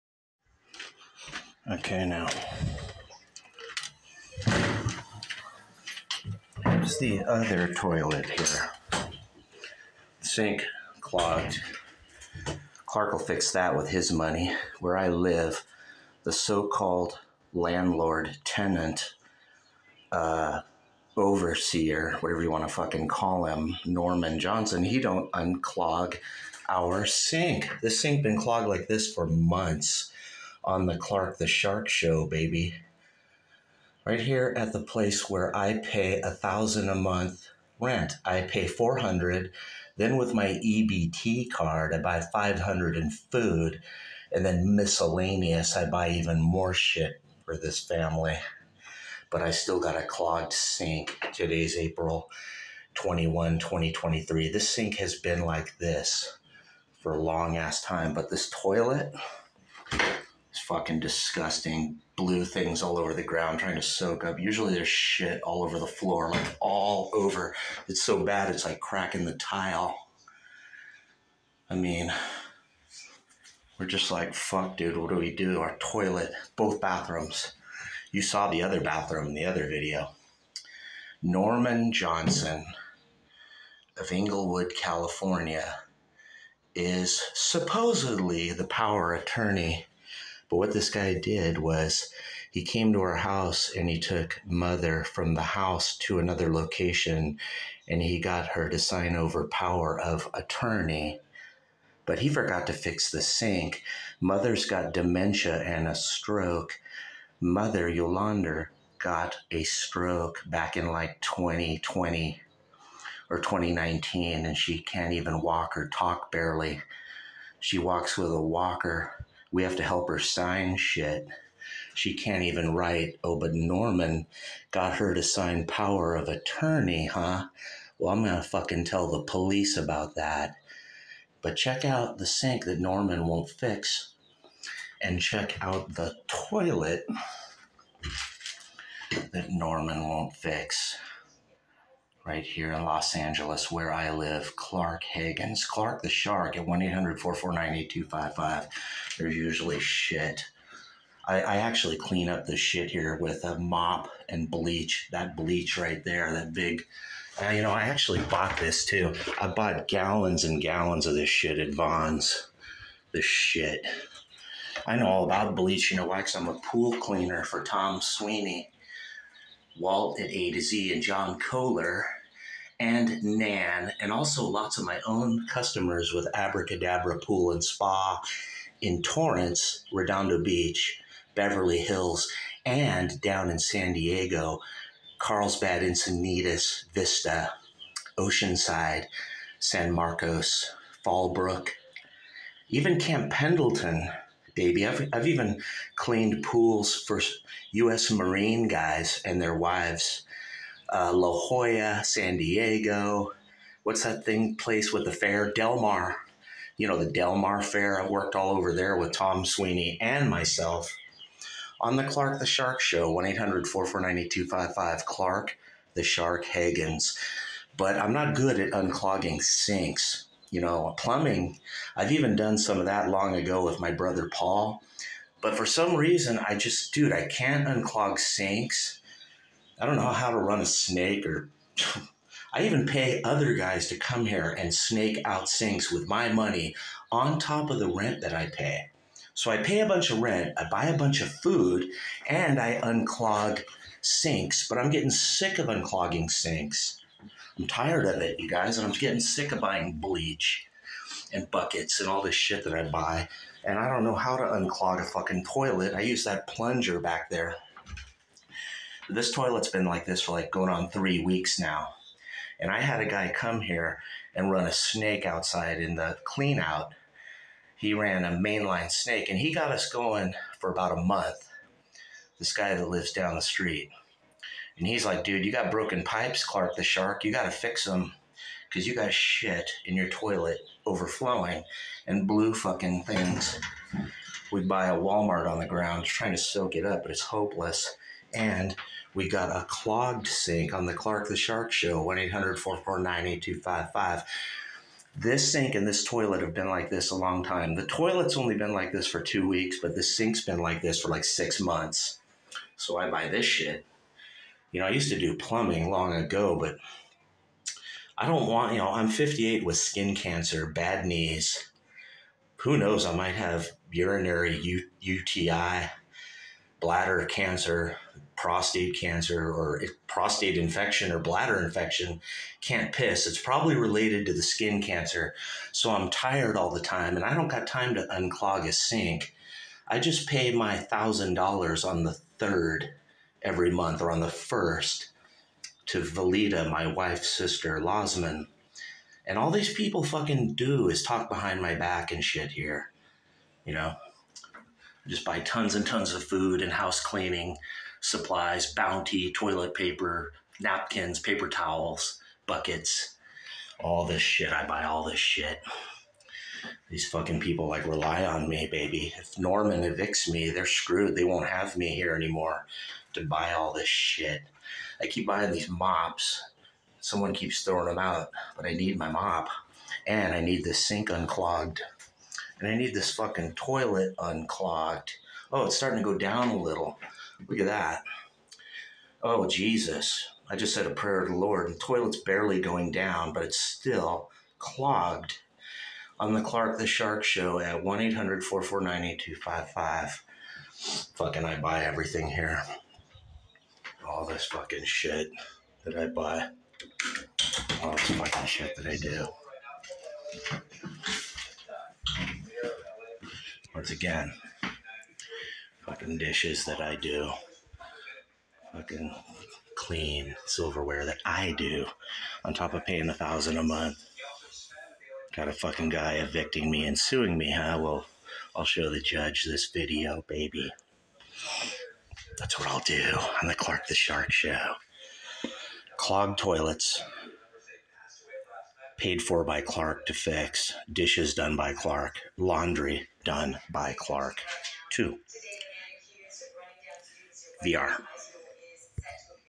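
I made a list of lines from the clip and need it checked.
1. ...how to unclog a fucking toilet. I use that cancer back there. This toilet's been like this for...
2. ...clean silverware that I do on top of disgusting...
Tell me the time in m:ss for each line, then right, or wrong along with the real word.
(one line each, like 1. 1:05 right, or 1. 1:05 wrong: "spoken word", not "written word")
1. 4:14 wrong: "plunger", not "cancer"
2. 6:49 wrong: "paying", not "disgusting".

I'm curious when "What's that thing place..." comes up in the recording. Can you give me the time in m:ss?
3:23.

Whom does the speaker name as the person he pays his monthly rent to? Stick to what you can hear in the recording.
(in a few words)
Valida.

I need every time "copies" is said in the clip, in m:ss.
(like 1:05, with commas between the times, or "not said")
not said.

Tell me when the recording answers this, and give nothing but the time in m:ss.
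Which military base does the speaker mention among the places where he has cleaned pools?
3:12.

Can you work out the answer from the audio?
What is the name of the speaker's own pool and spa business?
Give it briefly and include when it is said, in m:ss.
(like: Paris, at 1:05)
Abracadabra Pool and Spa, at 2:56.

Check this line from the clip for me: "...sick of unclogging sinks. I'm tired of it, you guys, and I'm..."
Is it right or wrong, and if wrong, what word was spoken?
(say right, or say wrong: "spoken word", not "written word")
right.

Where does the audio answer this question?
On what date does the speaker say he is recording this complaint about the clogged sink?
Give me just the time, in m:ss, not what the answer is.
0:51.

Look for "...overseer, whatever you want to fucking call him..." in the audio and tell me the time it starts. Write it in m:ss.
0:21.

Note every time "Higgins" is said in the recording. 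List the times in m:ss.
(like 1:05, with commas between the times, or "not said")
2:25, 3:36.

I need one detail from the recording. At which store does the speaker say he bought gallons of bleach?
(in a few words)
Vons.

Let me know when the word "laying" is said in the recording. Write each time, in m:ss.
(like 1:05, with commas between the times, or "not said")
not said.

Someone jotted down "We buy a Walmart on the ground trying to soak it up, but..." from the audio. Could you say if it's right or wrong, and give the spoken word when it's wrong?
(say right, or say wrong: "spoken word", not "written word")
right.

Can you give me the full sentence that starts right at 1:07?
It's so bad it's like cracking the tile.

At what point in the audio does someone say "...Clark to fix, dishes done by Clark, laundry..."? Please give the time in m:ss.
7:09.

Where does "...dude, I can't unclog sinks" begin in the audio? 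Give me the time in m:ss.
3:46.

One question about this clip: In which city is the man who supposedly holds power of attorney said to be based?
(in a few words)
Inglewood.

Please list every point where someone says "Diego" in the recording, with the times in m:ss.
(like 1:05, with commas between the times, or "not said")
3:03, 3:22.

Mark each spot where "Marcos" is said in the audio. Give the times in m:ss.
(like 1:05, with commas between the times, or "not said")
3:09.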